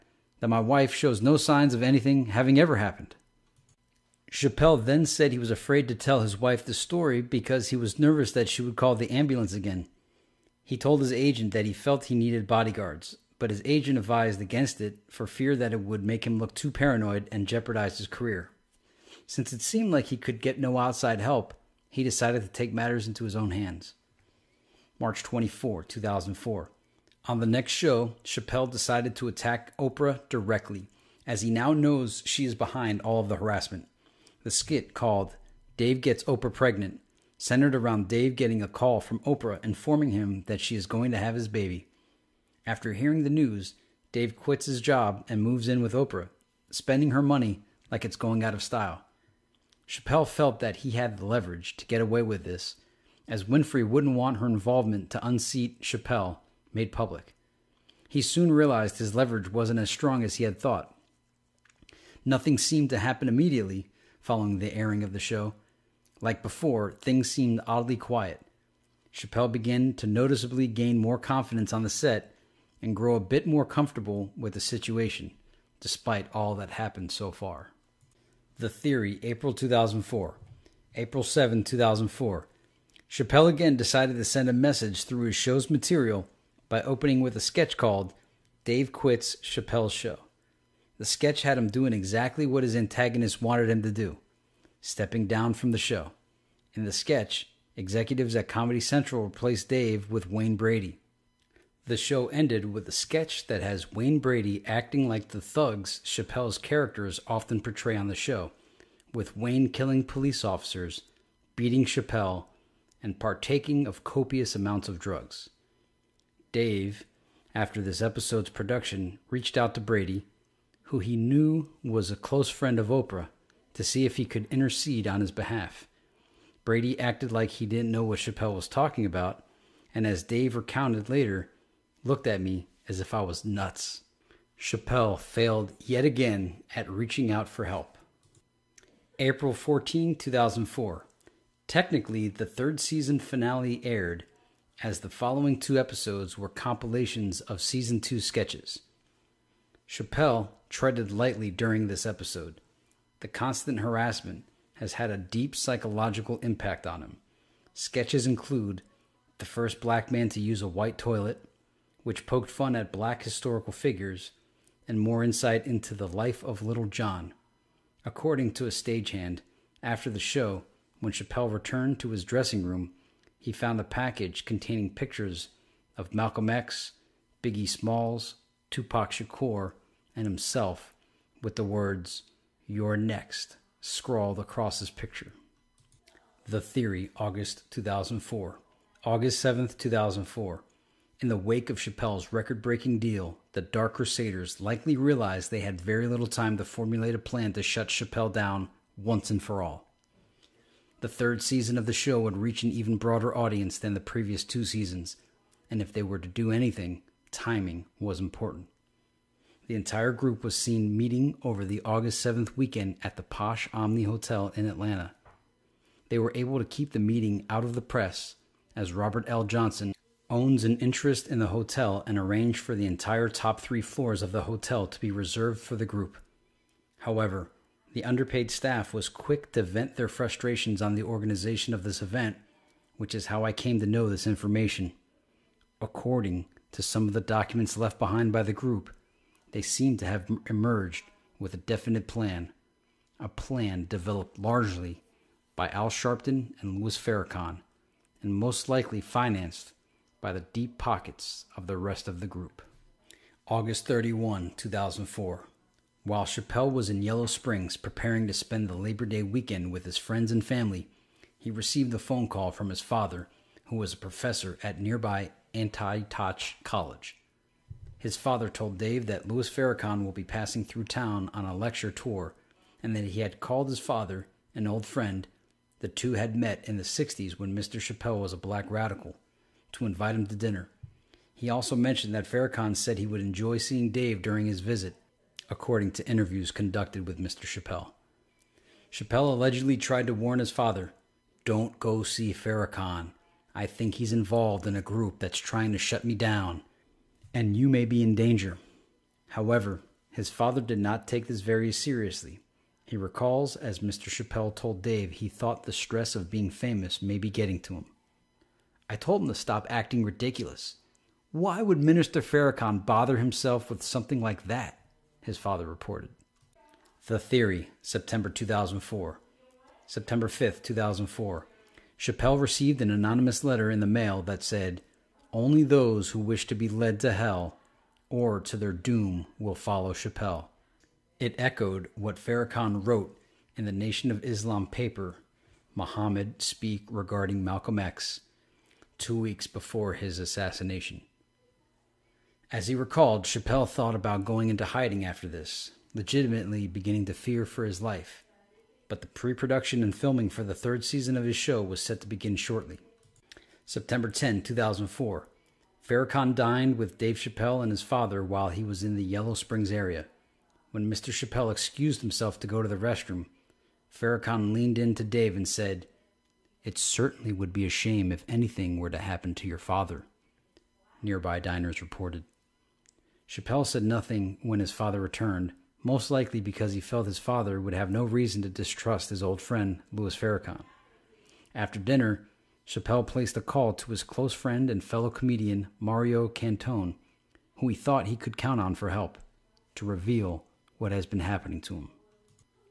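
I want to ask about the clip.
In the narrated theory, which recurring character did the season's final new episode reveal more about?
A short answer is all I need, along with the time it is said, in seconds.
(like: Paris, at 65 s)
Little John, at 166 s.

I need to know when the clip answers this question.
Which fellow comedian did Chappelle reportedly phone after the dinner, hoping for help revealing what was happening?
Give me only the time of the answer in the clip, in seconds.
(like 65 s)
385 s.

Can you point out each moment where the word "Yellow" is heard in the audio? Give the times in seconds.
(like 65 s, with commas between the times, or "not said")
257 s, 359 s.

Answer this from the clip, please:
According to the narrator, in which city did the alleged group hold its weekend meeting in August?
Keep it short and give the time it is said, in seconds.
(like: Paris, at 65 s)
Atlanta, at 214 s.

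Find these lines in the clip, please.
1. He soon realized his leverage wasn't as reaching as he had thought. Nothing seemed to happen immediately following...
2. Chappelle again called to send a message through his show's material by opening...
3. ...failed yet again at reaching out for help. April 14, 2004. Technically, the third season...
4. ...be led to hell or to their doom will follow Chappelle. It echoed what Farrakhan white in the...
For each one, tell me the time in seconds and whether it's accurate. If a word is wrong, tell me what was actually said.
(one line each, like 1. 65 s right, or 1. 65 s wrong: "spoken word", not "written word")
1. 58 s wrong: "strong", not "reaching"
2. 83 s wrong: "decided", not "called"
3. 135 s right
4. 326 s wrong: "wrote", not "white".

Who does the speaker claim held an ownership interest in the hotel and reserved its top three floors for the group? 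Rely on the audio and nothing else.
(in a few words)
Robert L. Johnson.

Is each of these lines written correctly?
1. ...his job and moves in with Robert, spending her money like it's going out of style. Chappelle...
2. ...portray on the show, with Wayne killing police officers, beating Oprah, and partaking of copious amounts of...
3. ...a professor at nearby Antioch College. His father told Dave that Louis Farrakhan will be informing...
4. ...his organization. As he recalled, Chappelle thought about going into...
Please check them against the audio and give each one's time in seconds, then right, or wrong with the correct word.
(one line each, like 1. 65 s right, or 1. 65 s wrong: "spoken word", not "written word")
1. 44 s wrong: "Oprah", not "Robert"
2. 107 s wrong: "Chappelle", not "Oprah"
3. 263 s wrong: "passing", not "informing"
4. 339 s wrong: "assassination", not "organization".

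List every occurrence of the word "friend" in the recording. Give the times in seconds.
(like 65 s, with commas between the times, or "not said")
122 s, 259 s, 274 s, 379 s, 384 s.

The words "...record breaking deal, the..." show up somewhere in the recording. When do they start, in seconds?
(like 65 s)
192 s.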